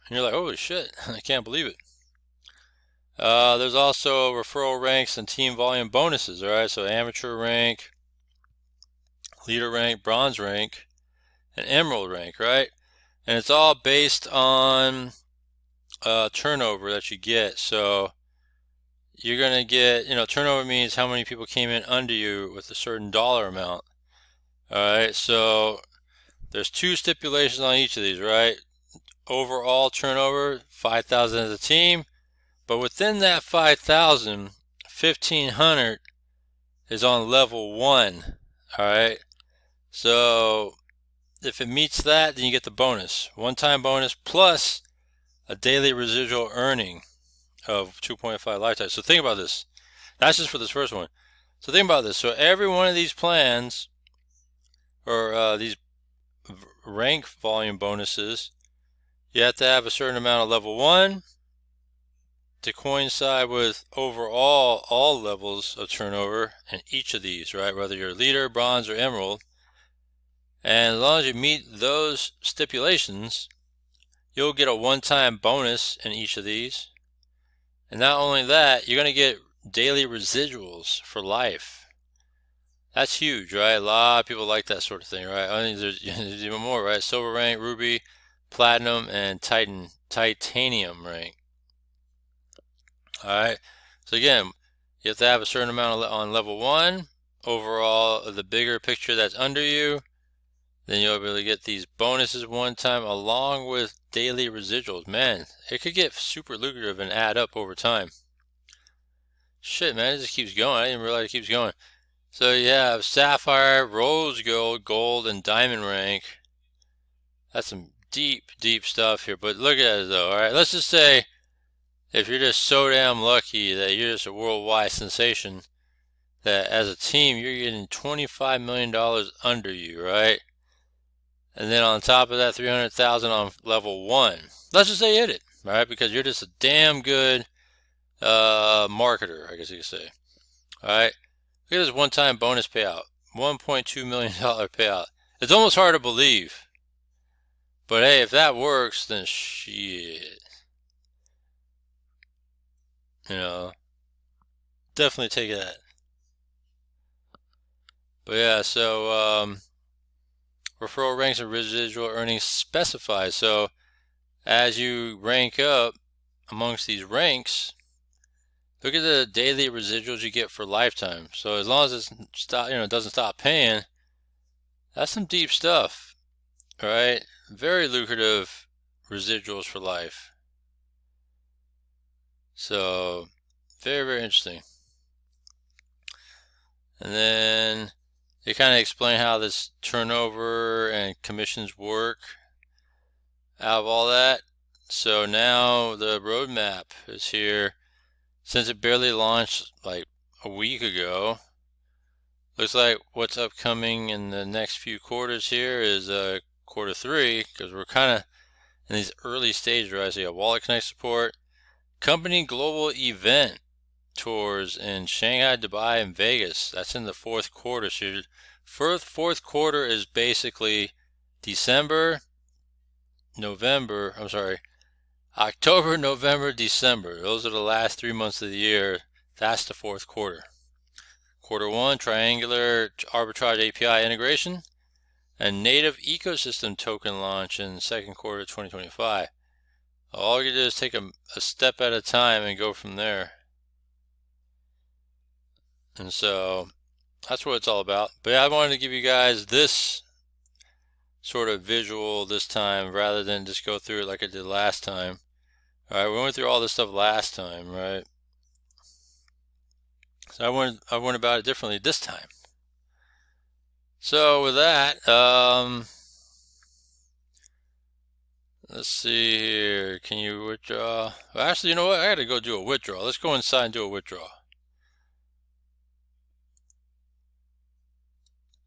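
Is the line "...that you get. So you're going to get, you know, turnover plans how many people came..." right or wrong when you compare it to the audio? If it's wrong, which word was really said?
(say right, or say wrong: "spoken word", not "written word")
wrong: "means", not "plans".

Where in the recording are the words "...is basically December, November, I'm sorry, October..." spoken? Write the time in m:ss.
3:39.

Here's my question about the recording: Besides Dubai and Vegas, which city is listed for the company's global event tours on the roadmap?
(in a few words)
Shanghai.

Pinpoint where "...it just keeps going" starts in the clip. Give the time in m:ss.
1:50.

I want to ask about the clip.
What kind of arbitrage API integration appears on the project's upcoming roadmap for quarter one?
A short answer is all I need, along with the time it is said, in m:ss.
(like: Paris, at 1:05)
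Triangular, at 3:51.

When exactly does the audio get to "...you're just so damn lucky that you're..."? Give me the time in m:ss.
2:02.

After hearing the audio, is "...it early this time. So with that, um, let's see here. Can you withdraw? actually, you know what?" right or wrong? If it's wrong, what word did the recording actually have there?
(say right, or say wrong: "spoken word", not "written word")
wrong: "differently", not "early".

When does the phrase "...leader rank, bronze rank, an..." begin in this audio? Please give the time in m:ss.
0:09.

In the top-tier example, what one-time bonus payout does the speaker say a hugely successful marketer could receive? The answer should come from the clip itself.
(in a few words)
$1.2 million.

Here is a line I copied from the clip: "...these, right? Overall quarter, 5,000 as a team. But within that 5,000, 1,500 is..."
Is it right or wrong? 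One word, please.
wrong.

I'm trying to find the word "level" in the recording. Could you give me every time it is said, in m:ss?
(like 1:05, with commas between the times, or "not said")
0:37, 1:00, 1:05, 1:36, 2:13.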